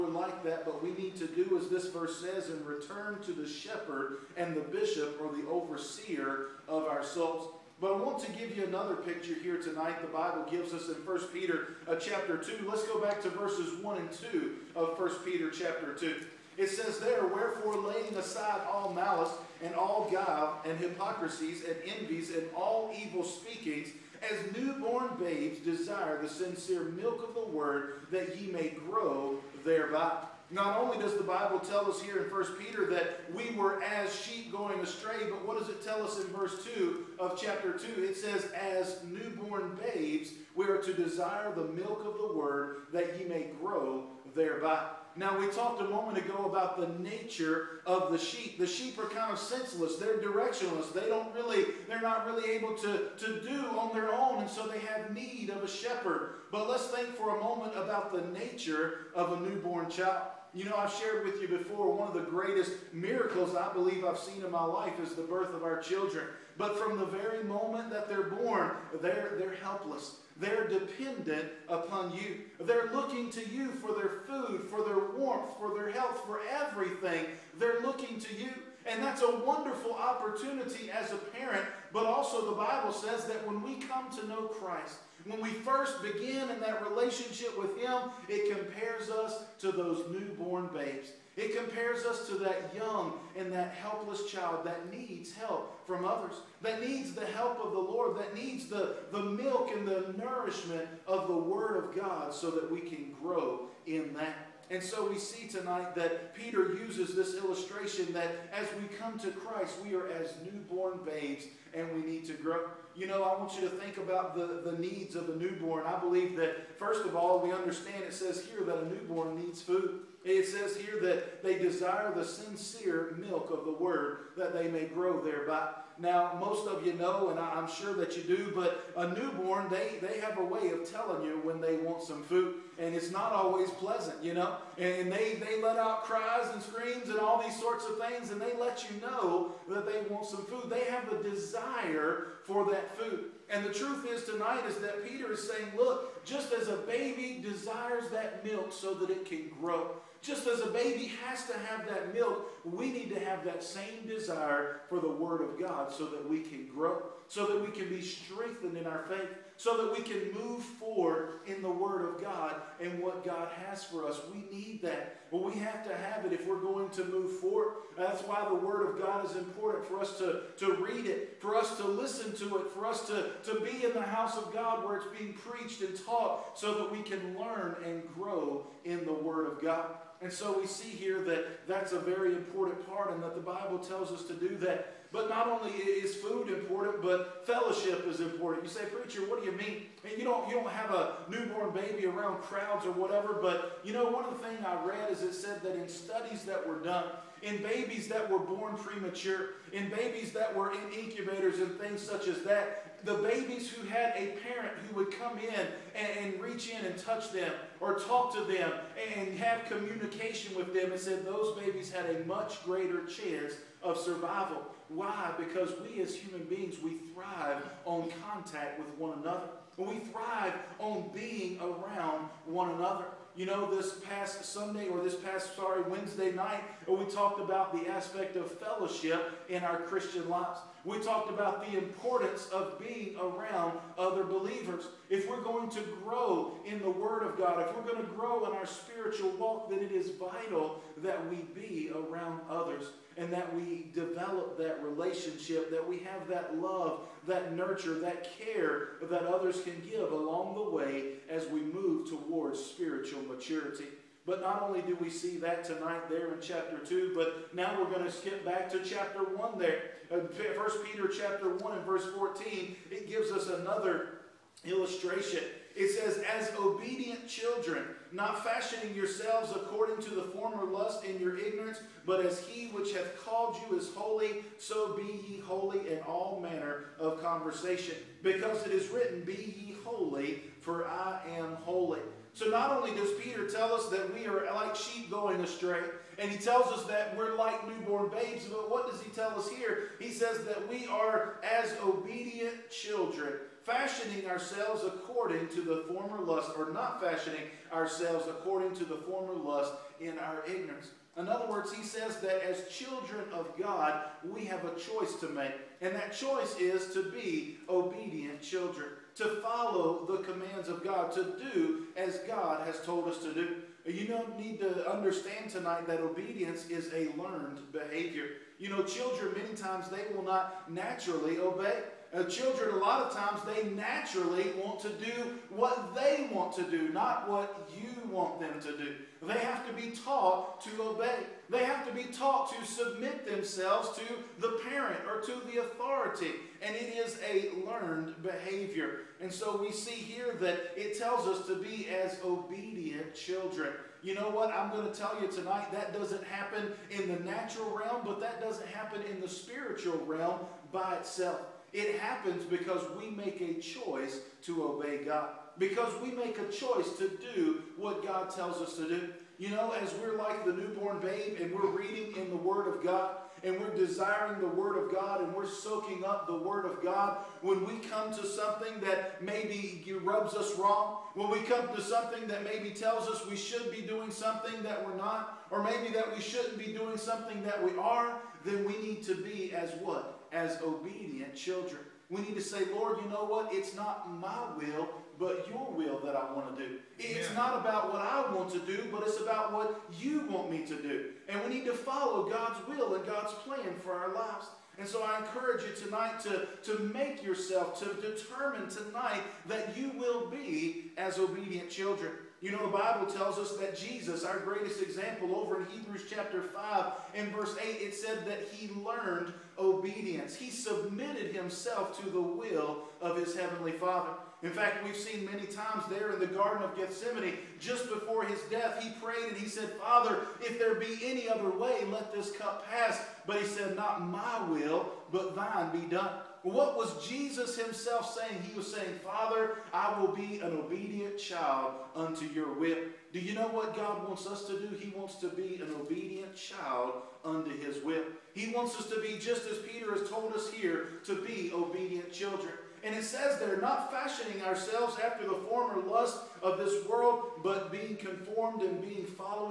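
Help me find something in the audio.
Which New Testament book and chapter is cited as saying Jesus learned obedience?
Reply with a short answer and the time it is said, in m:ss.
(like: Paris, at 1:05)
Hebrews chapter 5, at 6:45.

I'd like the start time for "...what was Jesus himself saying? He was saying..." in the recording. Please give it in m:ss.
7:06.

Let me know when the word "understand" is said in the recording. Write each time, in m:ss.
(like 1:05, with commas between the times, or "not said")
1:57, 5:14.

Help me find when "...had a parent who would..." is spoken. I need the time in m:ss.
3:23.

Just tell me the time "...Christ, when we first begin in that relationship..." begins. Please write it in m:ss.
1:24.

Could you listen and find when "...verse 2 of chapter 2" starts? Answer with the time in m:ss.
0:36.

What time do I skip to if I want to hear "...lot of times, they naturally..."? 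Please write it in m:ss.
5:22.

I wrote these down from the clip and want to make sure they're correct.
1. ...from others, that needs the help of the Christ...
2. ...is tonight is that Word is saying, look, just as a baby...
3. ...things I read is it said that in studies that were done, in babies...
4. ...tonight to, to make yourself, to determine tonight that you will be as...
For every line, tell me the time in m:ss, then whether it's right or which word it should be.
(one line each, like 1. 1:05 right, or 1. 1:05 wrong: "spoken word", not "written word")
1. 1:35 wrong: "Lord", not "Christ"
2. 2:24 wrong: "Peter", not "Word"
3. 3:14 right
4. 6:35 right.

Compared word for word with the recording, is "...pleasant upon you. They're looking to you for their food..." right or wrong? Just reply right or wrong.
wrong.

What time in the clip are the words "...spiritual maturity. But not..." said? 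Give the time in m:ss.
4:12.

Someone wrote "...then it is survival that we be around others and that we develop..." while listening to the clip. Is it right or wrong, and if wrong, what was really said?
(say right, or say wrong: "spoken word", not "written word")
wrong: "vital", not "survival".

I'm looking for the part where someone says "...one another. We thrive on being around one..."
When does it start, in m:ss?
3:38.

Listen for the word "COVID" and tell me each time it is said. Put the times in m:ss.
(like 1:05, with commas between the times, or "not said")
not said.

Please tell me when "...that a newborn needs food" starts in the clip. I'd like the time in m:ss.
1:58.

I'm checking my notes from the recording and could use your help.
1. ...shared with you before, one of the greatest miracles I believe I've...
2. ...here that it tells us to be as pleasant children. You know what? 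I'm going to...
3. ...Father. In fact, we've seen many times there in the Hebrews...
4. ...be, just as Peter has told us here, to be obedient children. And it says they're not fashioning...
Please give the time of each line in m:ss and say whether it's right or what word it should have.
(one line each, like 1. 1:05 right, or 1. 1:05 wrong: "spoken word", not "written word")
1. 1:00 right
2. 5:39 wrong: "obedient", not "pleasant"
3. 6:53 wrong: "Garden", not "Hebrews"
4. 7:18 right.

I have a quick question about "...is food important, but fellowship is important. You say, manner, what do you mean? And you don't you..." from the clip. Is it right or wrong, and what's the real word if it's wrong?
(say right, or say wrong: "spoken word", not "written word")
wrong: "preacher", not "manner".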